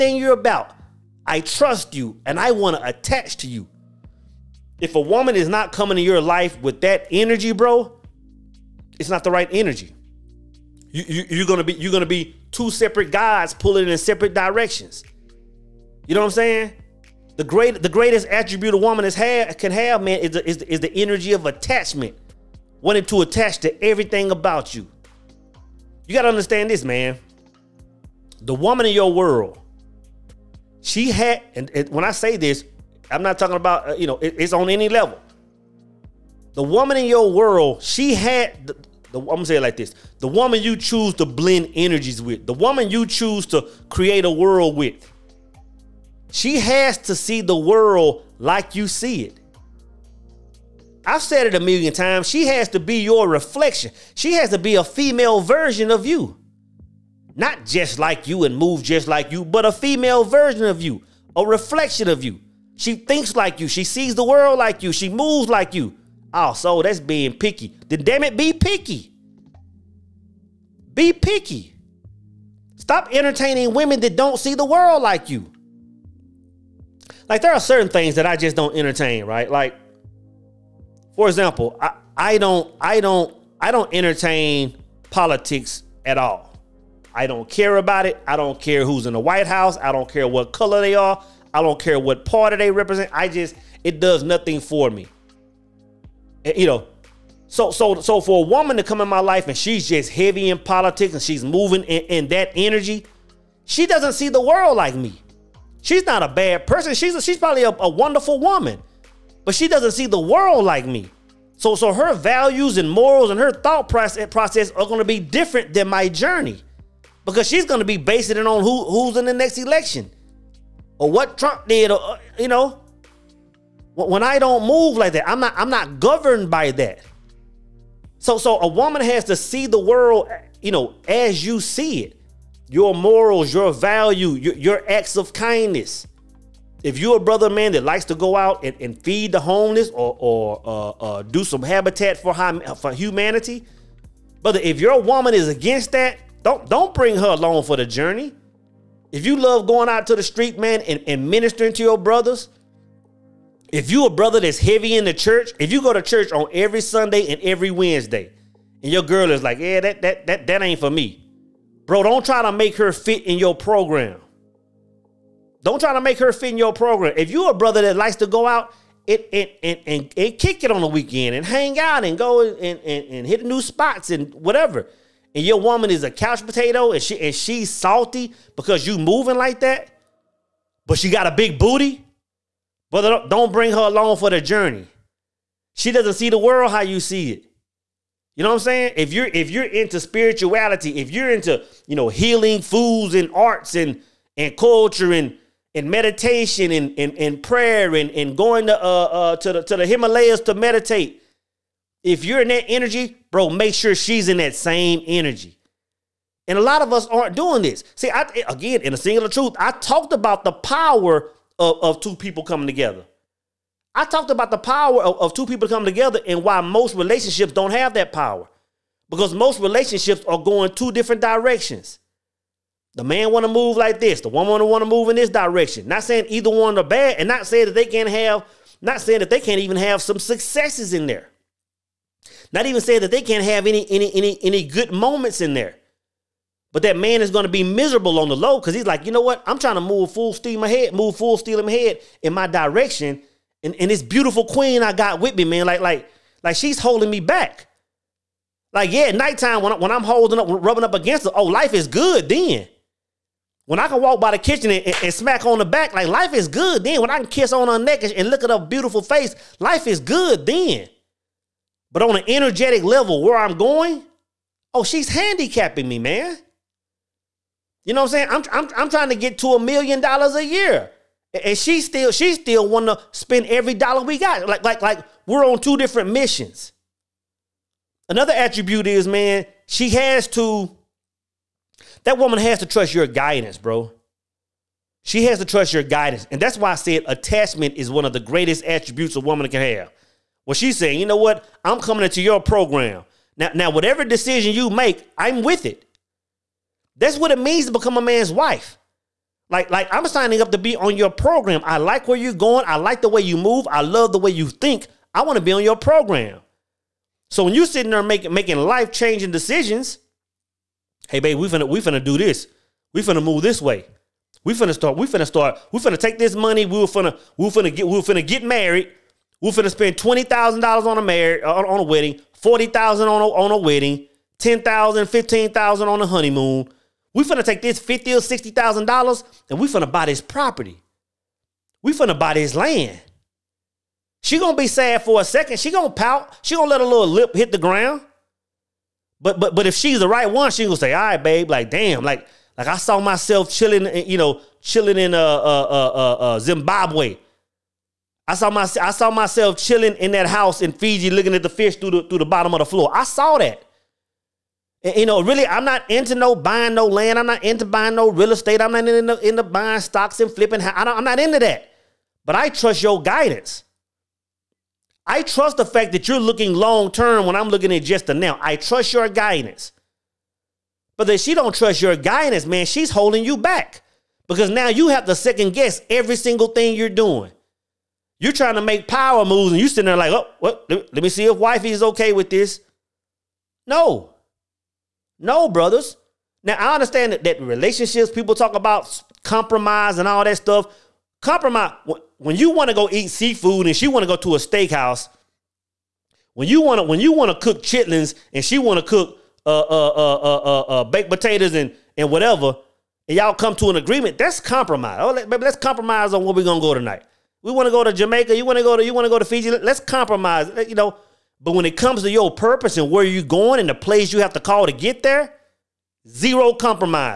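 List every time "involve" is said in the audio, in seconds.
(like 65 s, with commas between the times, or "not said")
not said.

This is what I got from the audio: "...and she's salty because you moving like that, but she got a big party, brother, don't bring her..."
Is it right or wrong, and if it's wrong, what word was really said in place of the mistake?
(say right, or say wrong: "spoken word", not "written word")
wrong: "booty", not "party".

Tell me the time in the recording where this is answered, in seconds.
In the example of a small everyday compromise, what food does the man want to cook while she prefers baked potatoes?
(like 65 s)
397 s.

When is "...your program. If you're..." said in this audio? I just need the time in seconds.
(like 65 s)
166 s.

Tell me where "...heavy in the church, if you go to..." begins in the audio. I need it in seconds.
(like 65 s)
154 s.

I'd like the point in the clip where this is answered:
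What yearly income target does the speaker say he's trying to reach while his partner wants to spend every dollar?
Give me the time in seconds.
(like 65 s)
269 s.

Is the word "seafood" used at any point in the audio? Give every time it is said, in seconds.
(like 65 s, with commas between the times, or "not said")
393 s.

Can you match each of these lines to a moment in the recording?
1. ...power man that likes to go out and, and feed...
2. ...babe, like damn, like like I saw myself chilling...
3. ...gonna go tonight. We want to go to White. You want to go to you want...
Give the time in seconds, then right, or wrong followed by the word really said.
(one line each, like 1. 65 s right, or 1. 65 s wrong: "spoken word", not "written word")
1. 137 s wrong: "brother", not "power"
2. 341 s right
3. 406 s wrong: "Jamaica", not "White".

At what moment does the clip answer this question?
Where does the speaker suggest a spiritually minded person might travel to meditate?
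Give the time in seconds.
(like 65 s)
199 s.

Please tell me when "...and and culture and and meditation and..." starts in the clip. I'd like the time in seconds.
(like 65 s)
193 s.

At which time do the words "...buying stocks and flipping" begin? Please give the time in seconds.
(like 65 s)
359 s.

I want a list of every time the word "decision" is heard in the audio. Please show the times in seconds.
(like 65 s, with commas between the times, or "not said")
294 s, 309 s.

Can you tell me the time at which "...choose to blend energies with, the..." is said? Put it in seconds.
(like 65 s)
40 s.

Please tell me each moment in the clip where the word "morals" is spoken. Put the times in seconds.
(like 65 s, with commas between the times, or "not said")
112 s, 132 s.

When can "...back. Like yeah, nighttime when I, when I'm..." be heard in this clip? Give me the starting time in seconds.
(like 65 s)
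247 s.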